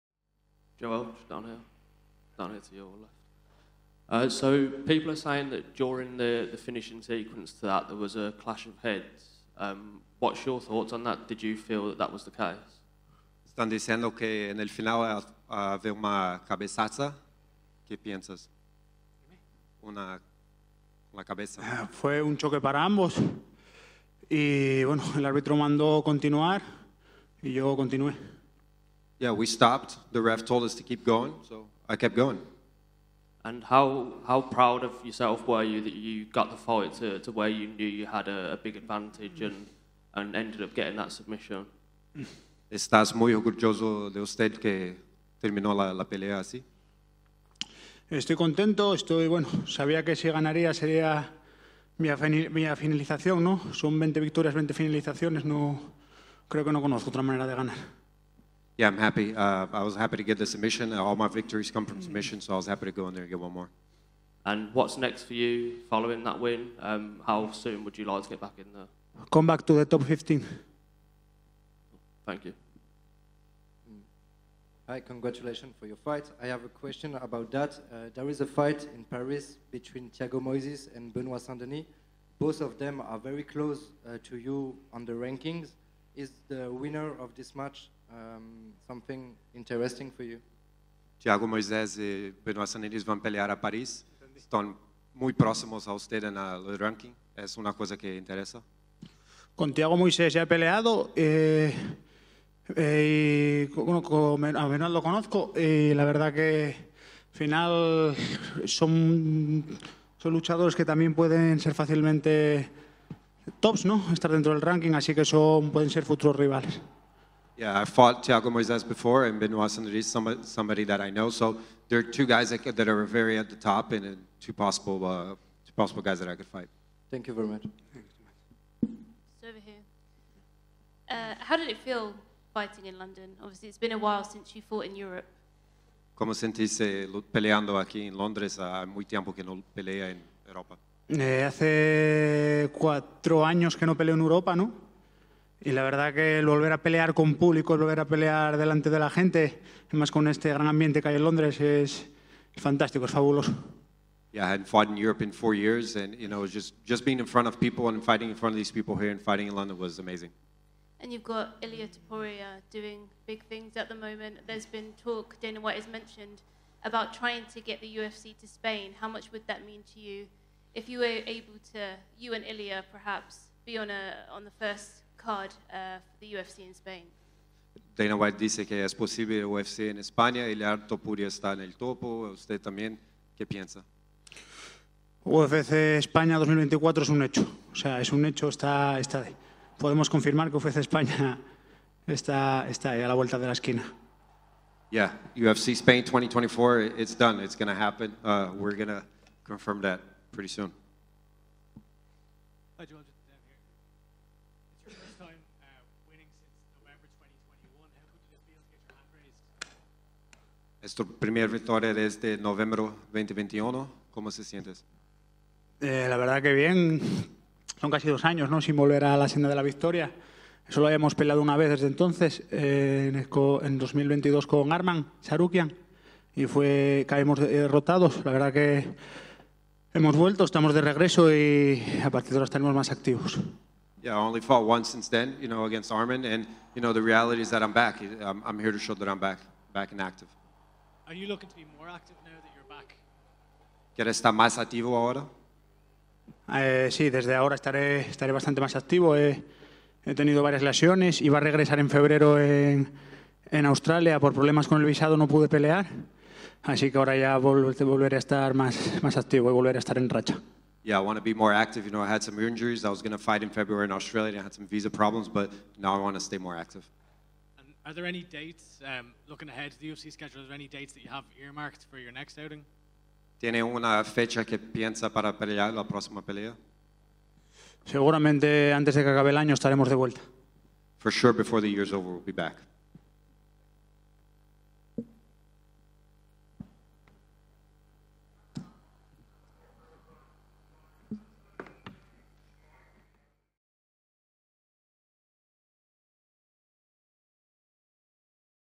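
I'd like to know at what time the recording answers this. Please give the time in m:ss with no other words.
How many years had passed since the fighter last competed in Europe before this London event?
2:21.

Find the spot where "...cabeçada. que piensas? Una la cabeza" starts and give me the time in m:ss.
0:16.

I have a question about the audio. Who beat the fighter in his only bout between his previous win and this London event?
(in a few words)
Arman Sarukian.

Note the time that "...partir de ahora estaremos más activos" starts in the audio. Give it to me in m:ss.
3:52.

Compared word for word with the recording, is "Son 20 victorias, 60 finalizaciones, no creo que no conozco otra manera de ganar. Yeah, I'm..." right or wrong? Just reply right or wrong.
wrong.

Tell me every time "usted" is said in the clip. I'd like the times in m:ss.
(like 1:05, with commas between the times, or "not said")
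0:44, 3:02.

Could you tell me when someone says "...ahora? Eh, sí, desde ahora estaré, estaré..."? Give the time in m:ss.
4:04.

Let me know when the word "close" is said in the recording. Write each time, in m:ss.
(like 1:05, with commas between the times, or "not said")
1:23.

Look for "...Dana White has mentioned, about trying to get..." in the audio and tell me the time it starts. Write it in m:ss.
2:45.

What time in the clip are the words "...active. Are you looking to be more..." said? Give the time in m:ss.
4:00.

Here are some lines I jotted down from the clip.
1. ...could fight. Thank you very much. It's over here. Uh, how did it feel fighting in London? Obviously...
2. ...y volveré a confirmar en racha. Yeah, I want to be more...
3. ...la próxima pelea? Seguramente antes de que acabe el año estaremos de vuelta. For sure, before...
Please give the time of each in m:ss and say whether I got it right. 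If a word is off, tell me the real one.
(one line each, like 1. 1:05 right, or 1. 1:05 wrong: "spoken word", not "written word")
1. 2:06 right
2. 4:19 wrong: "estar", not "confirmar"
3. 4:35 right.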